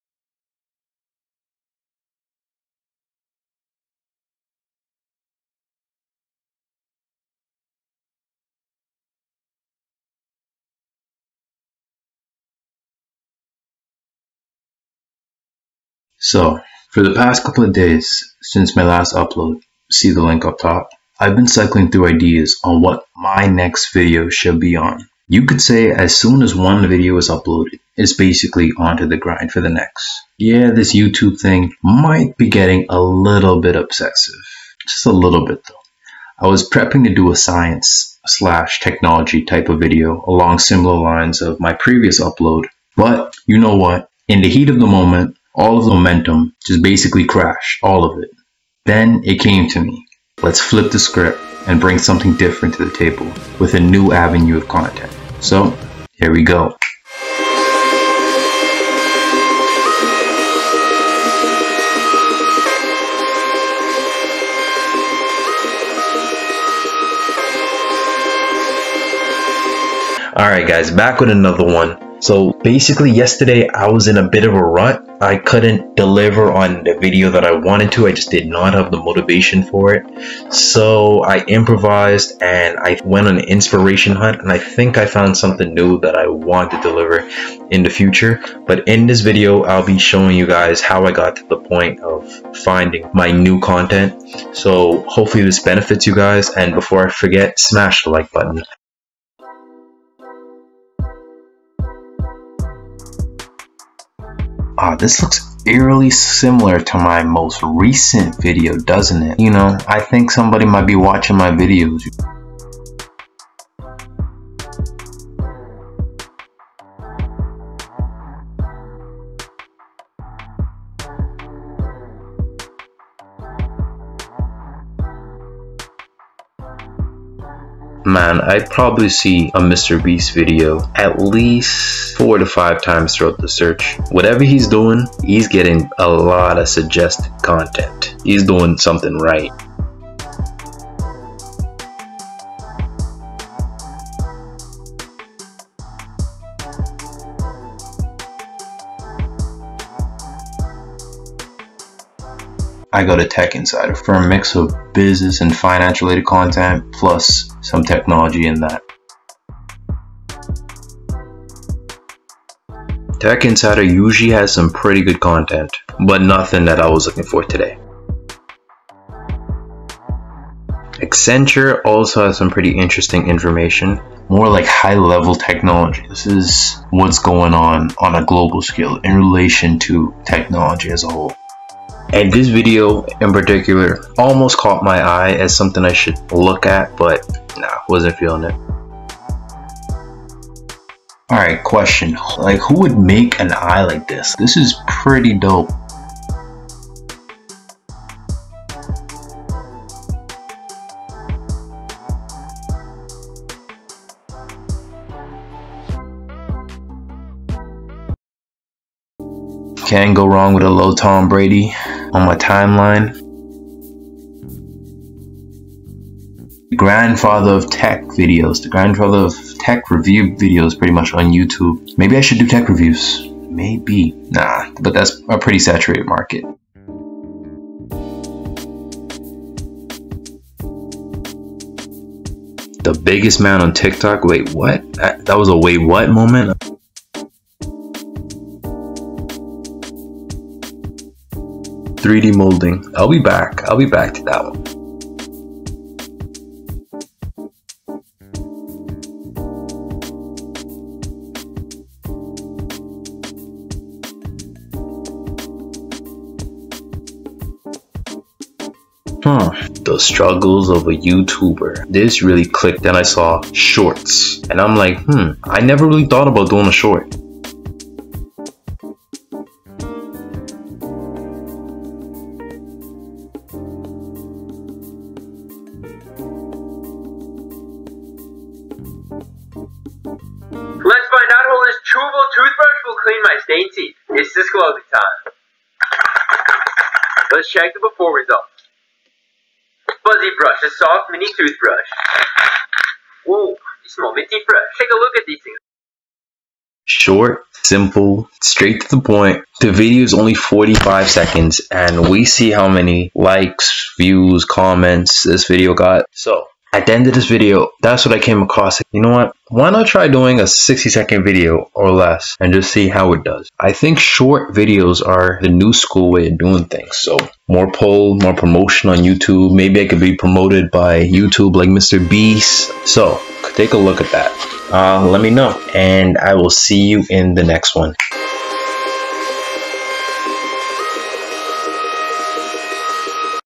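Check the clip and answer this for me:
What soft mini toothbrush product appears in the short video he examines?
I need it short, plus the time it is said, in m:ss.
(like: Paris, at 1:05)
Fuzzy brush, at 4:50.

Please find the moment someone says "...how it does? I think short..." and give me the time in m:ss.
5:12.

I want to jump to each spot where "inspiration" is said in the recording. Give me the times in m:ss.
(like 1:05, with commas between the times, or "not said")
1:23.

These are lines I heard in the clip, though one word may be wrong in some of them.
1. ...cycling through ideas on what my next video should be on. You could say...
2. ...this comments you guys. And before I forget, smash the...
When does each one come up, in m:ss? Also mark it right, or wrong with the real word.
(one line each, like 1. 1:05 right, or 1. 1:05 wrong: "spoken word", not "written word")
1. 0:21 right
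2. 1:35 wrong: "benefits", not "comments".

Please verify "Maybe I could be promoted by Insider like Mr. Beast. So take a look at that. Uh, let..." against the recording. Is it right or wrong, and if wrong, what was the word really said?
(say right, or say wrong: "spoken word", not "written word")
wrong: "YouTube", not "Insider".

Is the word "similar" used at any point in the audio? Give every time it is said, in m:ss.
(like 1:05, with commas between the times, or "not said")
0:40, 1:46.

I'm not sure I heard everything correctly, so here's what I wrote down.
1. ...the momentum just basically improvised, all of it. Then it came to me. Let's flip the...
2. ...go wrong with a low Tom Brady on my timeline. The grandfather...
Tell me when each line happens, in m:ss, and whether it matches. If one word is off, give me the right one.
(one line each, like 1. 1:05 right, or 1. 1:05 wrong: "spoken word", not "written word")
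1. 0:45 wrong: "crashed", not "improvised"
2. 3:30 right.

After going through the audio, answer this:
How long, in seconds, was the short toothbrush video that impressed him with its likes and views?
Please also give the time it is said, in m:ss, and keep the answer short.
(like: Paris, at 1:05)
45 seconds, at 5:00.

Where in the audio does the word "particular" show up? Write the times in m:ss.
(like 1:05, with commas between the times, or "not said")
3:03.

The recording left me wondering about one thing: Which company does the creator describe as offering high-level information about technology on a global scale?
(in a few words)
Accenture.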